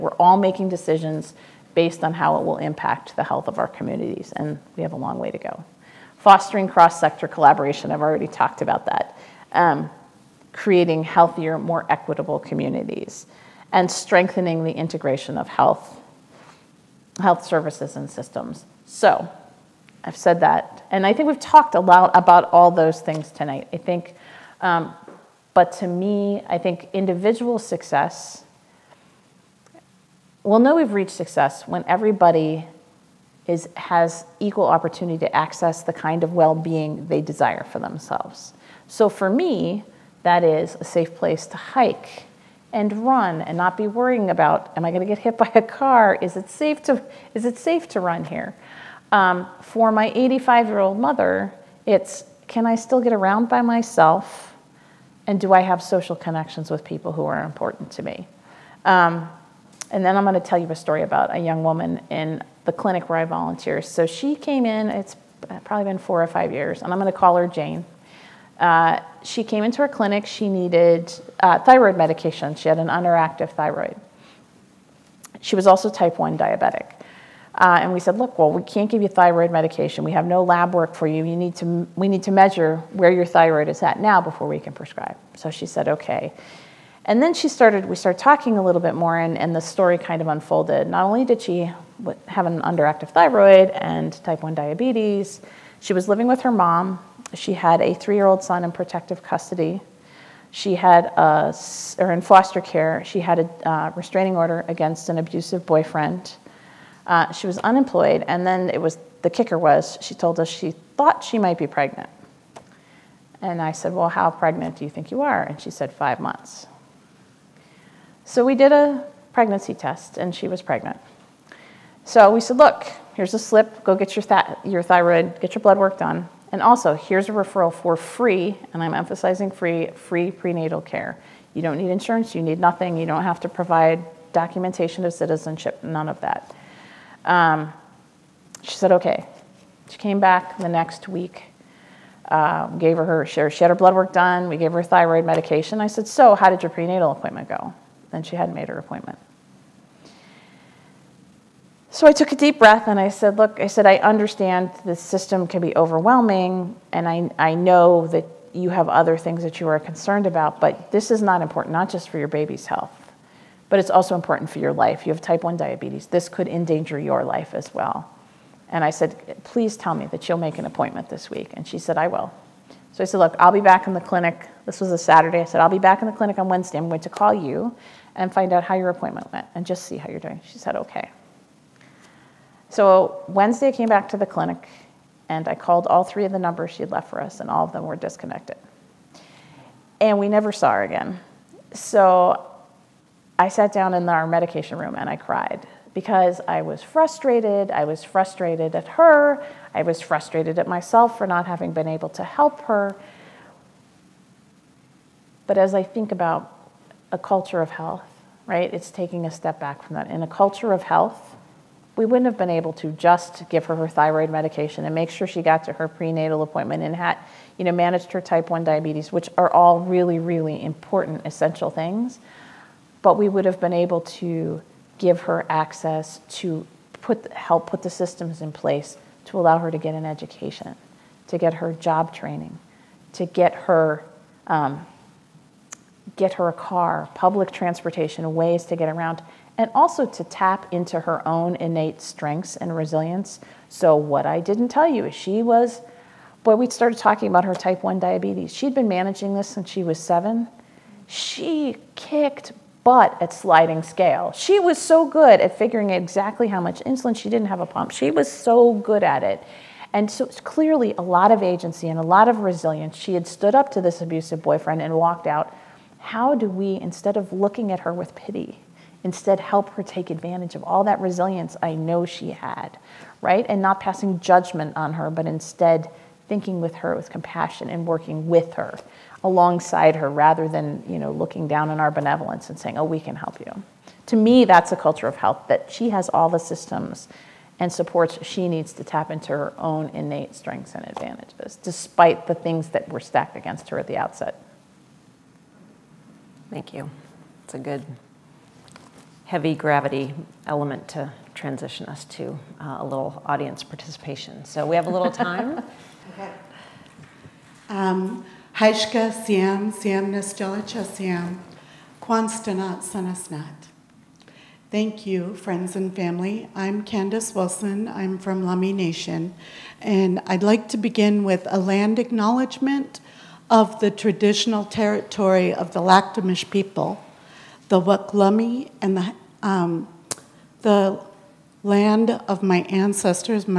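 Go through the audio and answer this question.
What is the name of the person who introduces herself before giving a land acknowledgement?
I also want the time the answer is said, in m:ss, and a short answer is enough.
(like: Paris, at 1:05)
Candace Wilson, at 5:16.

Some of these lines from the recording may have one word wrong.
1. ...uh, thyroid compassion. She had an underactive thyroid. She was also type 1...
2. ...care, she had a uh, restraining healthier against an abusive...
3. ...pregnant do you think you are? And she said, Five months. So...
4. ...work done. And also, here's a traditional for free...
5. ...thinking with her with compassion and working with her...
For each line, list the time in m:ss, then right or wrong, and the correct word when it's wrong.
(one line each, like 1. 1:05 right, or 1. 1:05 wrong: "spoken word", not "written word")
1. 1:11 wrong: "medication", not "compassion"
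2. 1:42 wrong: "order", not "healthier"
3. 1:54 right
4. 2:05 wrong: "referral", not "traditional"
5. 4:36 right.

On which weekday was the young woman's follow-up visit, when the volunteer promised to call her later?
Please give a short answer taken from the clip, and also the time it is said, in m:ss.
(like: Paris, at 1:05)
Saturday, at 2:54.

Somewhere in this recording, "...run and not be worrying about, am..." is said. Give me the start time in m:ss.
0:43.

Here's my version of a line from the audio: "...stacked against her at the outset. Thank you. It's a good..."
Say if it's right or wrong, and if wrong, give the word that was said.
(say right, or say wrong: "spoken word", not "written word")
right.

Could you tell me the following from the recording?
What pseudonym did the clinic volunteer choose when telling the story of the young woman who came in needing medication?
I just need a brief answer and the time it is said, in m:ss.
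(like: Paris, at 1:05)
Jane, at 1:07.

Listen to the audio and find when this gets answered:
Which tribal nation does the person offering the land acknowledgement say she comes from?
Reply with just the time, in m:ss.
5:18.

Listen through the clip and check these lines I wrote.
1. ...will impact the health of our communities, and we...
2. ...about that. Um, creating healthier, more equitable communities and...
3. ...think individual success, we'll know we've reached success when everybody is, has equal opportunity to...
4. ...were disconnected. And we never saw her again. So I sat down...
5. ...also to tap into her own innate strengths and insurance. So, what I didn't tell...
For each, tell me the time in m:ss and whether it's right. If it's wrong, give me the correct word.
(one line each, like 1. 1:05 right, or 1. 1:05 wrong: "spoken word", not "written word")
1. 0:02 right
2. 0:08 right
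3. 0:26 right
4. 3:07 right
5. 3:59 wrong: "resilience", not "insurance".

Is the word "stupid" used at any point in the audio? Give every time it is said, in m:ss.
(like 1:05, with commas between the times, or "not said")
not said.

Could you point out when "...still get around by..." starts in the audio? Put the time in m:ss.
0:52.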